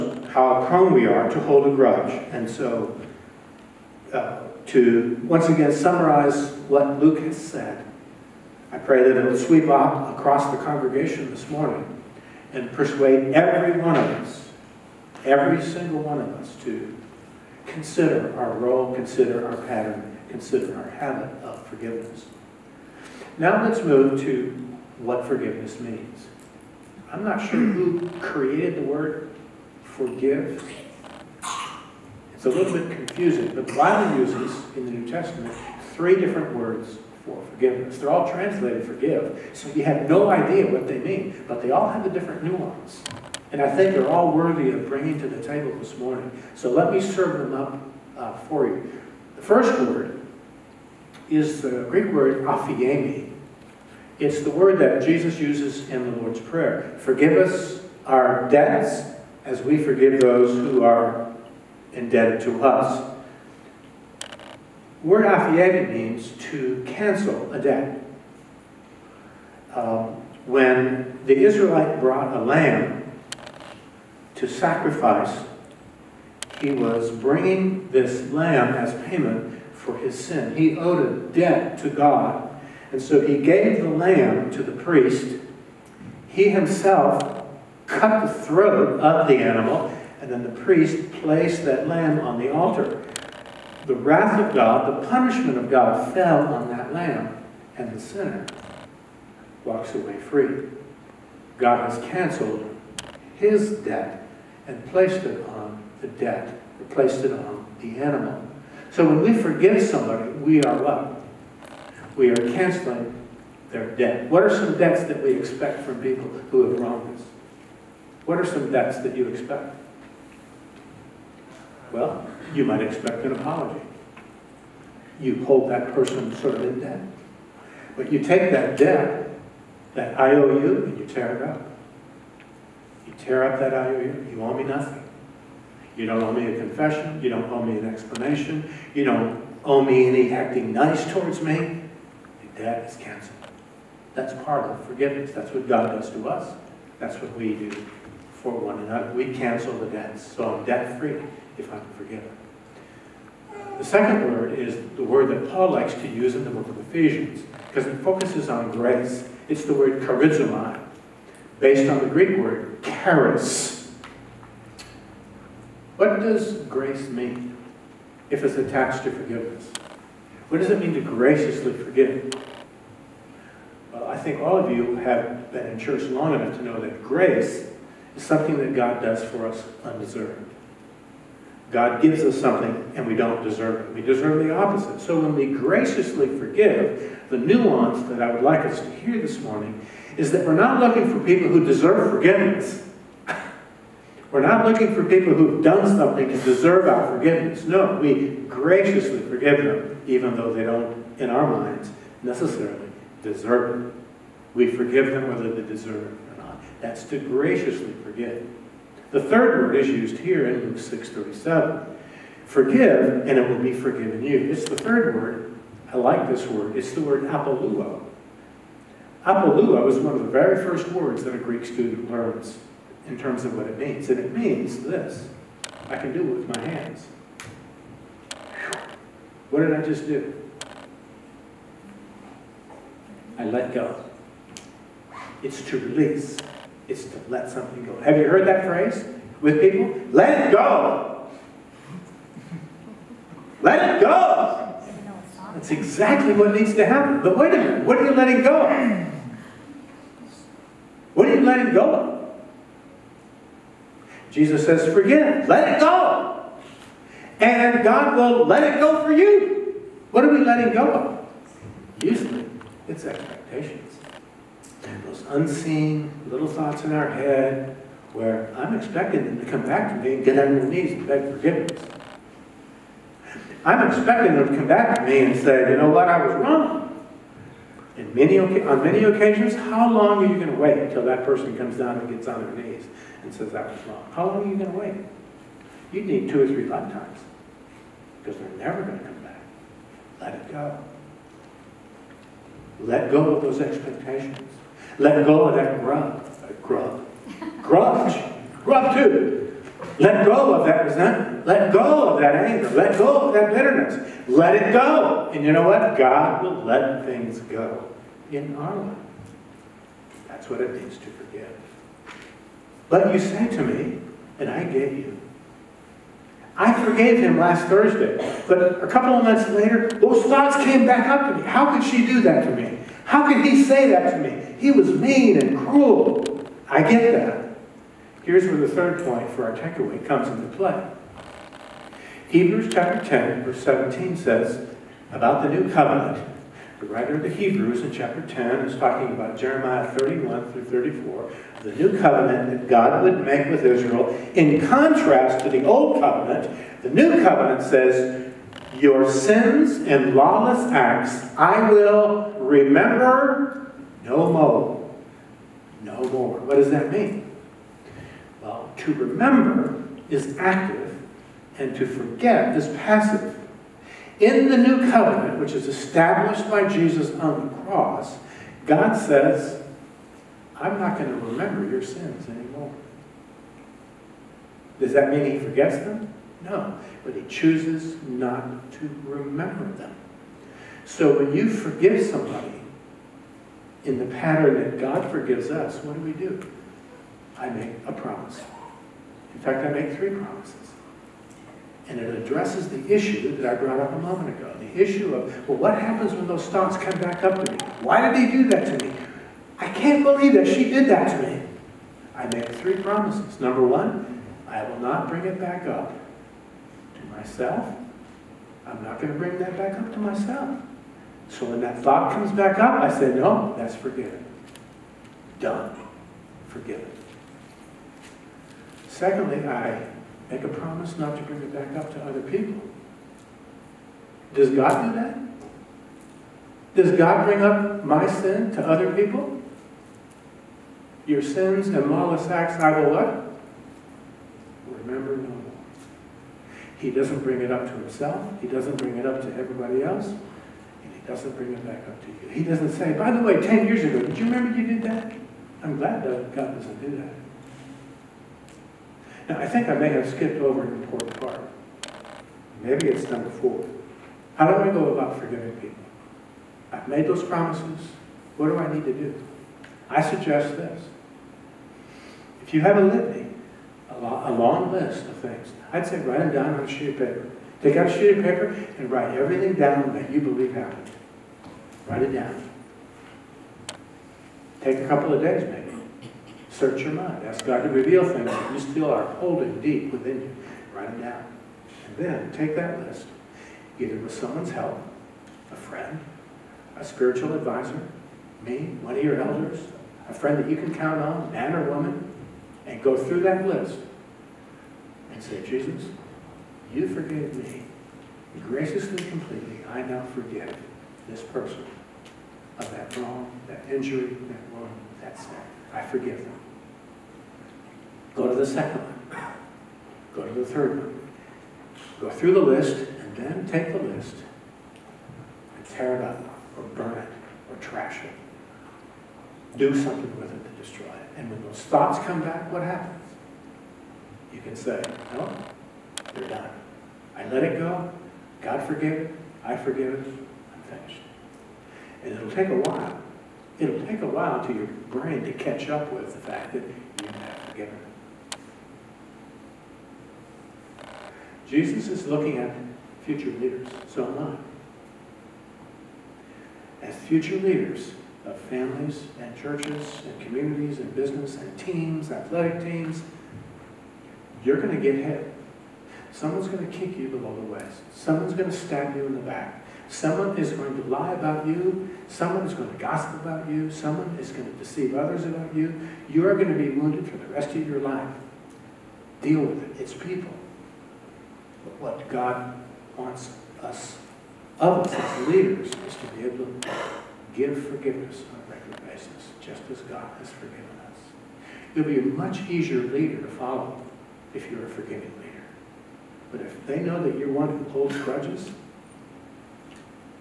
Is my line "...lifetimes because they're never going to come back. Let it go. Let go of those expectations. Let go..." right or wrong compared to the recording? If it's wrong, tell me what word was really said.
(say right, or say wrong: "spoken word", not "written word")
right.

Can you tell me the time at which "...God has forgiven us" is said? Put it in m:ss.
9:39.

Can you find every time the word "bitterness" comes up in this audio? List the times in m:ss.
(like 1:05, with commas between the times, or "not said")
5:03.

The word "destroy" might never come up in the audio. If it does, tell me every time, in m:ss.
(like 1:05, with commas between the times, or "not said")
8:40.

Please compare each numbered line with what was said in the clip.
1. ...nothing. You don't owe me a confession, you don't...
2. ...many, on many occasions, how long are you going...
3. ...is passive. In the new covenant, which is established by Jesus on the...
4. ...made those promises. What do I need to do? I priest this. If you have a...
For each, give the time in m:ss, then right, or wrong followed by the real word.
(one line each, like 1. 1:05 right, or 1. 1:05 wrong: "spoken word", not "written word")
1. 2:14 right
2. 4:38 right
3. 6:02 right
4. 7:36 wrong: "suggest", not "priest".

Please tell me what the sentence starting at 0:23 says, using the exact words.
Now let's move to what forgiveness means.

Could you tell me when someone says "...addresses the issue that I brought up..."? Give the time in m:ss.
6:32.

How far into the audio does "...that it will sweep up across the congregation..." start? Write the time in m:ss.
0:09.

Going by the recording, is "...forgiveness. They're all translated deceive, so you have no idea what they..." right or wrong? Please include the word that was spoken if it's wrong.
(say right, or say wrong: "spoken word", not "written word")
wrong: "forgive", not "deceive".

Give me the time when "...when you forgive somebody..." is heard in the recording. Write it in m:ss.
6:21.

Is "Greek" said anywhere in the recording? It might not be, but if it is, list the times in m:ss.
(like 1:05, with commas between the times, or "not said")
0:51, 2:42, 3:41.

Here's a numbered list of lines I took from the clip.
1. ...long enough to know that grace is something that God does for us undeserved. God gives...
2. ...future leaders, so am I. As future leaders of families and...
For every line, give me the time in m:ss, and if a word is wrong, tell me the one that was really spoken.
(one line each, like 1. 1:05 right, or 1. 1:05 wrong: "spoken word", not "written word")
1. 2:56 right
2. 9:03 right.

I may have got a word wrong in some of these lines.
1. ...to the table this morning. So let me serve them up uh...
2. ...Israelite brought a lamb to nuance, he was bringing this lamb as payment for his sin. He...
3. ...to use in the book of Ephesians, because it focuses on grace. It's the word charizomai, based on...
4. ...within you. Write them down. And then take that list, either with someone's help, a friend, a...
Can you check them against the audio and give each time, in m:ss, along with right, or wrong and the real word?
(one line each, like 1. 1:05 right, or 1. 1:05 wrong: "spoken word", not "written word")
1. 0:45 right
2. 1:11 wrong: "sacrifice", not "nuance"
3. 2:35 right
4. 7:59 right.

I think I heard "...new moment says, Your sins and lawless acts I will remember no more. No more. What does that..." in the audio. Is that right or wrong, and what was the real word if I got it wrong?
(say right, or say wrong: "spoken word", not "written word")
wrong: "covenant", not "moment".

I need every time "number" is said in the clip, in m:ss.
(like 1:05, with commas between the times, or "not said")
6:43, 7:33.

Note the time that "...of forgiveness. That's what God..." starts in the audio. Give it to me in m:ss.
2:24.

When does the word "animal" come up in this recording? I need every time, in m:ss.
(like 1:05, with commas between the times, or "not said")
1:29, 1:47.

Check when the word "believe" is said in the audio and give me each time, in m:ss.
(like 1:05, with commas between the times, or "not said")
6:40, 7:50.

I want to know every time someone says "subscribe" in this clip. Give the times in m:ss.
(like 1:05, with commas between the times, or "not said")
not said.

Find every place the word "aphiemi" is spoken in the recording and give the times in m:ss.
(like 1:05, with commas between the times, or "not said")
0:52, 1:05.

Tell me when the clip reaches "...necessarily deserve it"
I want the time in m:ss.
3:22.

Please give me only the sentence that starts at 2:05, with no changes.
You hold that person sort of in debt.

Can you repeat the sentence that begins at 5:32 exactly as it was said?
Hebrews chapter 10, verse 17 says about the new covenant.